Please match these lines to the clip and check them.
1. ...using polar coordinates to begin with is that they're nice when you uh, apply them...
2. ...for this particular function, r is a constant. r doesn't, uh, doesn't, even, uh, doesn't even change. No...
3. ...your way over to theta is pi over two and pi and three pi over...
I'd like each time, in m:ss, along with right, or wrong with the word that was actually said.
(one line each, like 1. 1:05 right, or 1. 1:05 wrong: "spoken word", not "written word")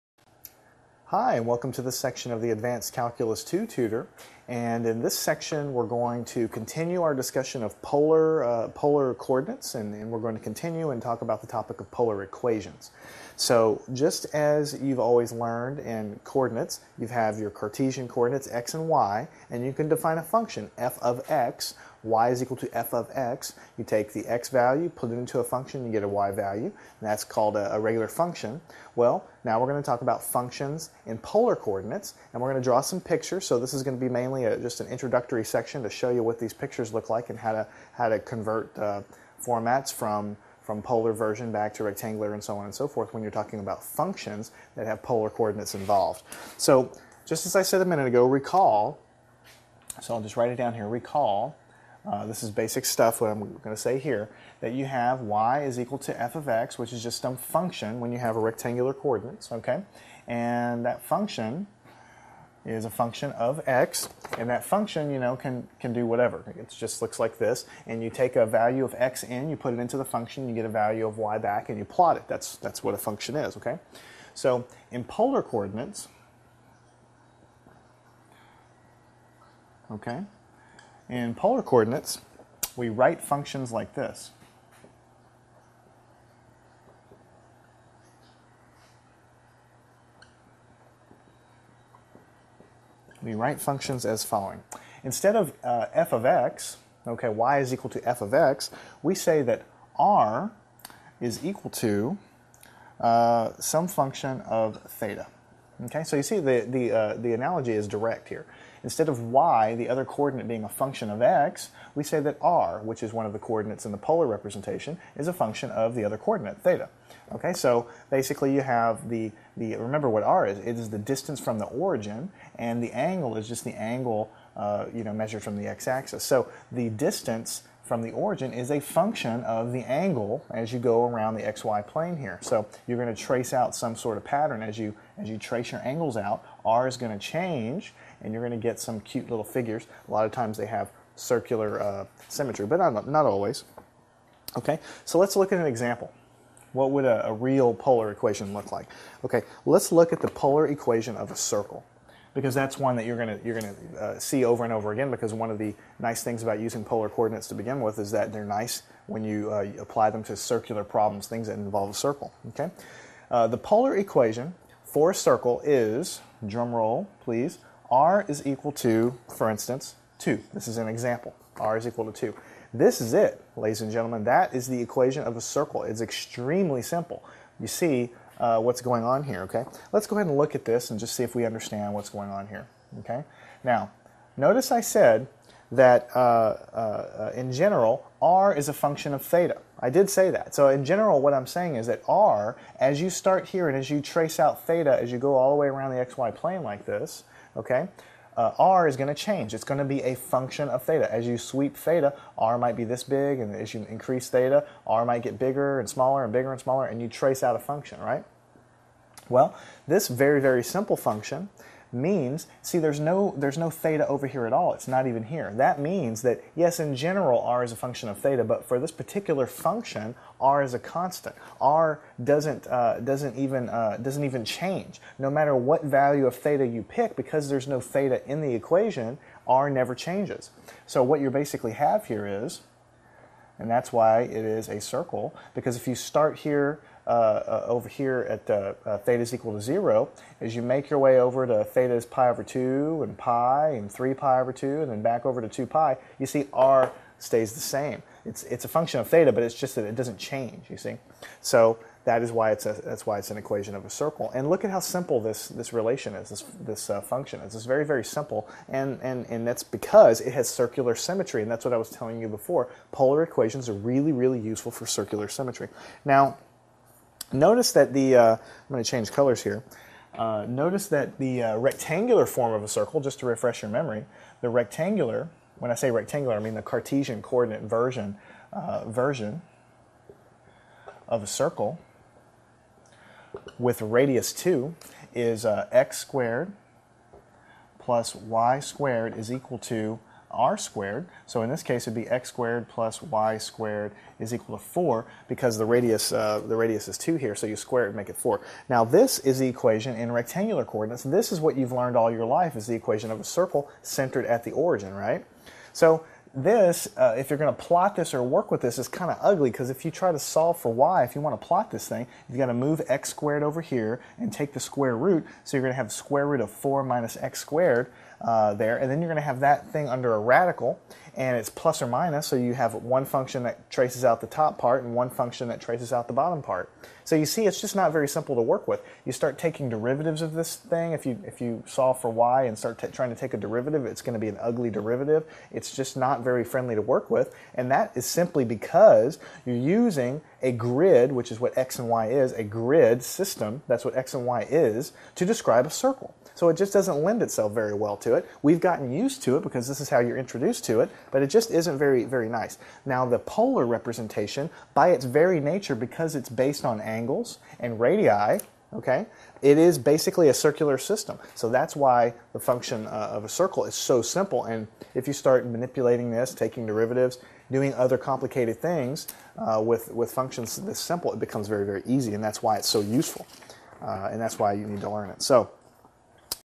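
1. 2:36 right
2. 3:38 right
3. 4:00 right.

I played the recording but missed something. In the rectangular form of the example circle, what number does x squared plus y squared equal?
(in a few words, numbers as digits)
4.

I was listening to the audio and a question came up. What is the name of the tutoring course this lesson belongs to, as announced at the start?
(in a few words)
Advanced Calculus 2.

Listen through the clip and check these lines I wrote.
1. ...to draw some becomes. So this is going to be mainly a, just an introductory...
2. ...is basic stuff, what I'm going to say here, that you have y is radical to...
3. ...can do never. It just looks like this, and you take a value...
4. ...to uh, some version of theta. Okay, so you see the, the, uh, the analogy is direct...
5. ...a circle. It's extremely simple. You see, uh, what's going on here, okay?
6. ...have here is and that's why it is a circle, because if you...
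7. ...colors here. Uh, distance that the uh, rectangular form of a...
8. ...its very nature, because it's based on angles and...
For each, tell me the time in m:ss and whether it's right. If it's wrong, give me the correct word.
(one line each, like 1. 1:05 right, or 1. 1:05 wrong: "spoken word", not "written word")
1. 0:32 wrong: "pictures", not "becomes"
2. 0:52 wrong: "equal", not "radical"
3. 1:05 wrong: "whatever", not "never"
4. 1:41 wrong: "function", not "version"
5. 2:55 right
6. 3:51 right
7. 4:29 wrong: "notice", not "distance"
8. 5:54 right.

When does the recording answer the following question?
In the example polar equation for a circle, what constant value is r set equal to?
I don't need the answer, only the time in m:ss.
2:51.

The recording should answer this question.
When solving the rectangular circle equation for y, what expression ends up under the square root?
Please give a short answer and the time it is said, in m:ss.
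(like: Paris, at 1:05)
4 minus x squared, at 5:16.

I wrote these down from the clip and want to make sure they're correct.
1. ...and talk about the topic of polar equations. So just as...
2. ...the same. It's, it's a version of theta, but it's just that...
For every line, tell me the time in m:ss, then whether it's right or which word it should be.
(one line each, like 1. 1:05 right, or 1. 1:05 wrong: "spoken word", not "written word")
1. 0:10 right
2. 4:07 wrong: "function", not "version".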